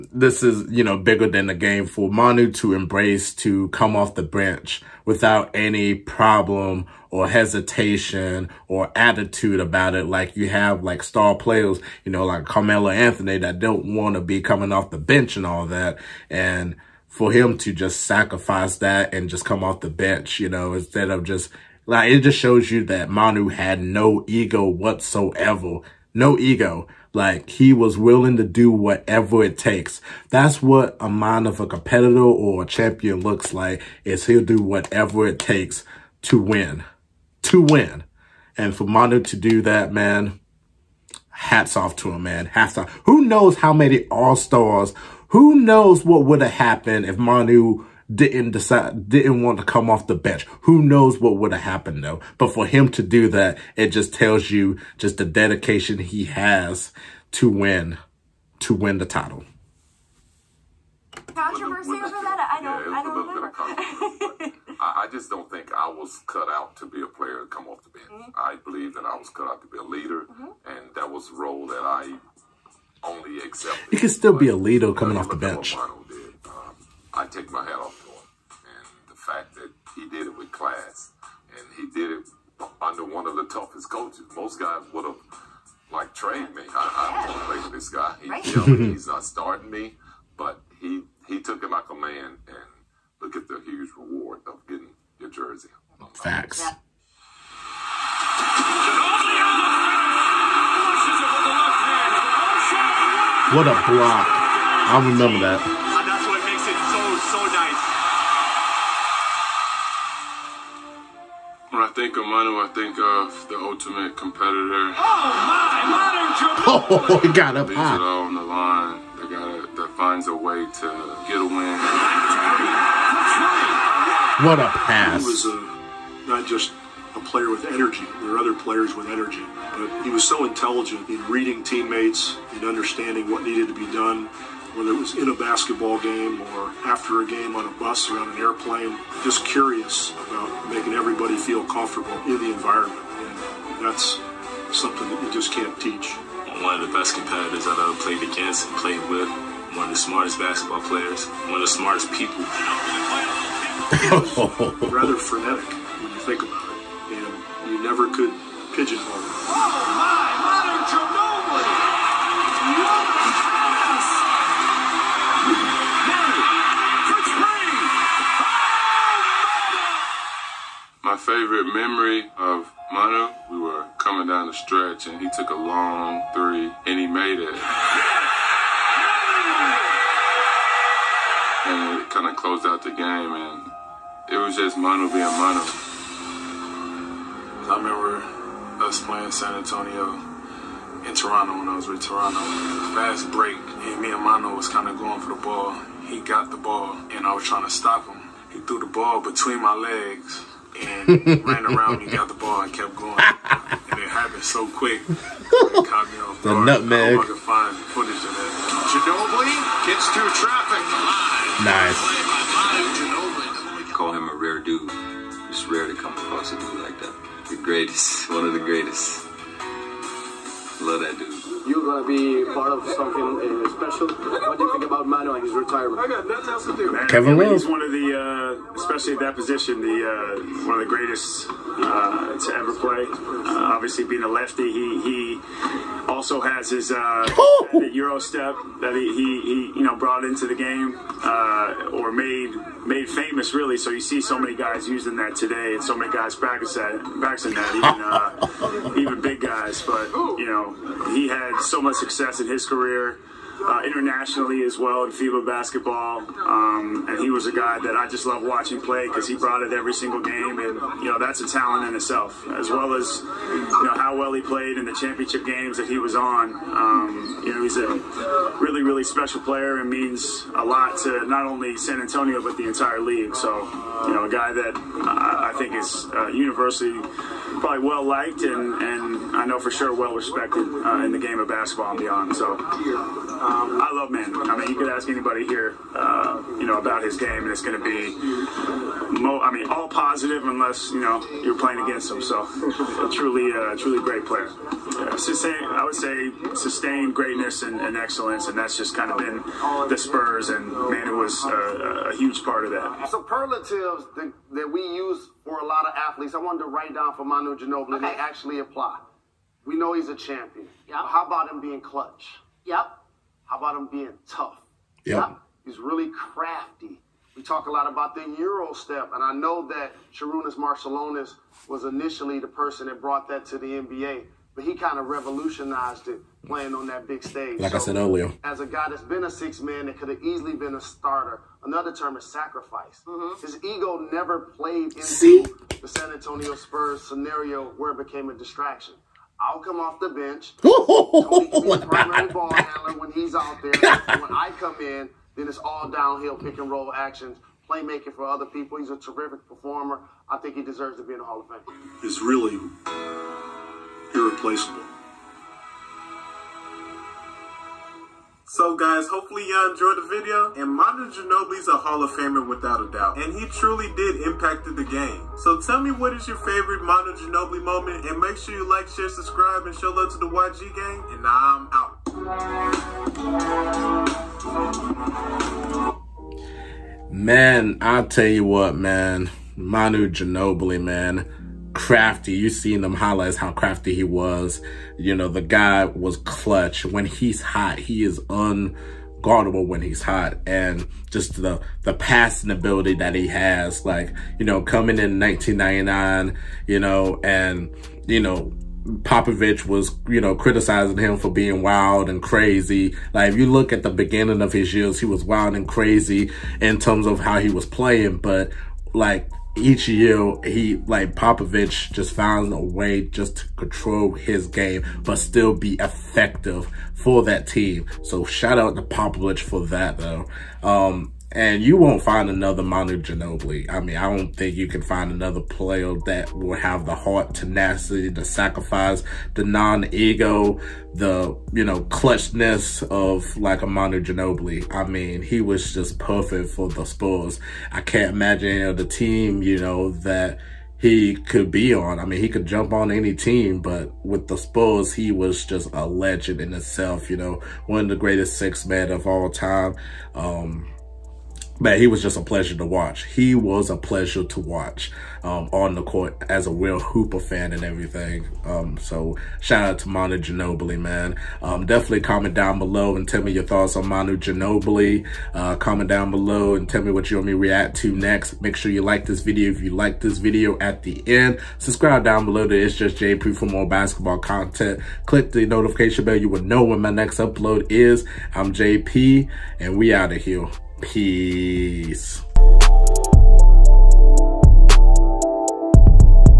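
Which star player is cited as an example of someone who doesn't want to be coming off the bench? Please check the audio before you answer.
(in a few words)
Carmelo Anthony.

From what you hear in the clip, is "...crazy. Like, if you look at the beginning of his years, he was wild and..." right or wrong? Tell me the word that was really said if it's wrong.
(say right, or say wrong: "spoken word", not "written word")
right.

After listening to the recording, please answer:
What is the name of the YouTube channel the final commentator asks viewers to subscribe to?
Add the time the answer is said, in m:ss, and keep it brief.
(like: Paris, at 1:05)
It's Just JP, at 7:52.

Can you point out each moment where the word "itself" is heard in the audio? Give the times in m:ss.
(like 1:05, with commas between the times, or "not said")
4:21, 7:26.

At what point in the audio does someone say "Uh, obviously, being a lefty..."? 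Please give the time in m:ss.
3:53.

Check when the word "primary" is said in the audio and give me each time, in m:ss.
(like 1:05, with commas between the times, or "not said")
5:41.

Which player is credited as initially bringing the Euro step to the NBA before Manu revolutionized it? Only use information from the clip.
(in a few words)
Sarunas Marciulionis.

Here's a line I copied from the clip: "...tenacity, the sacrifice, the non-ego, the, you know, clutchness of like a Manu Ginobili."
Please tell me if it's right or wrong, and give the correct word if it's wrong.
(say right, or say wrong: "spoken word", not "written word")
right.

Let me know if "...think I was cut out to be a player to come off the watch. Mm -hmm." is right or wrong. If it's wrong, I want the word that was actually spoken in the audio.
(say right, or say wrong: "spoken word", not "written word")
wrong: "bench", not "watch".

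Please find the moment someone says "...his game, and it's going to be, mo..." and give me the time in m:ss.
4:47.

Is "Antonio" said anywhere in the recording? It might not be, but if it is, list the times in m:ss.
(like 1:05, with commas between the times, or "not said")
3:09, 4:32, 5:36.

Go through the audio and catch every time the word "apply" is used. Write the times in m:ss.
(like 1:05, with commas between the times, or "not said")
5:08.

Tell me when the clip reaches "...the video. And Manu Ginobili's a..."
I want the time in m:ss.
5:59.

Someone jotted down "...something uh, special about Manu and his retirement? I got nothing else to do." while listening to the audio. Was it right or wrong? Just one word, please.
right.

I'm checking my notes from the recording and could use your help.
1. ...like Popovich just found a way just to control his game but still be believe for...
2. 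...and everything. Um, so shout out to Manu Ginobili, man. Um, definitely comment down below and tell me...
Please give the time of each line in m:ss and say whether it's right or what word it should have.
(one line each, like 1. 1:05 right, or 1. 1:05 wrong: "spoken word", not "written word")
1. 6:50 wrong: "effective", not "believe"
2. 7:37 right.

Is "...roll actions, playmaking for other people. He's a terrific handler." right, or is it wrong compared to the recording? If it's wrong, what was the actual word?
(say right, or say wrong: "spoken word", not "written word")
wrong: "performer", not "handler".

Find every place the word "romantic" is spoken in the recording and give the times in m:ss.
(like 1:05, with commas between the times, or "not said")
not said.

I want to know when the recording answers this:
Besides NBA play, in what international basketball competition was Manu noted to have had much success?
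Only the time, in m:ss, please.
4:15.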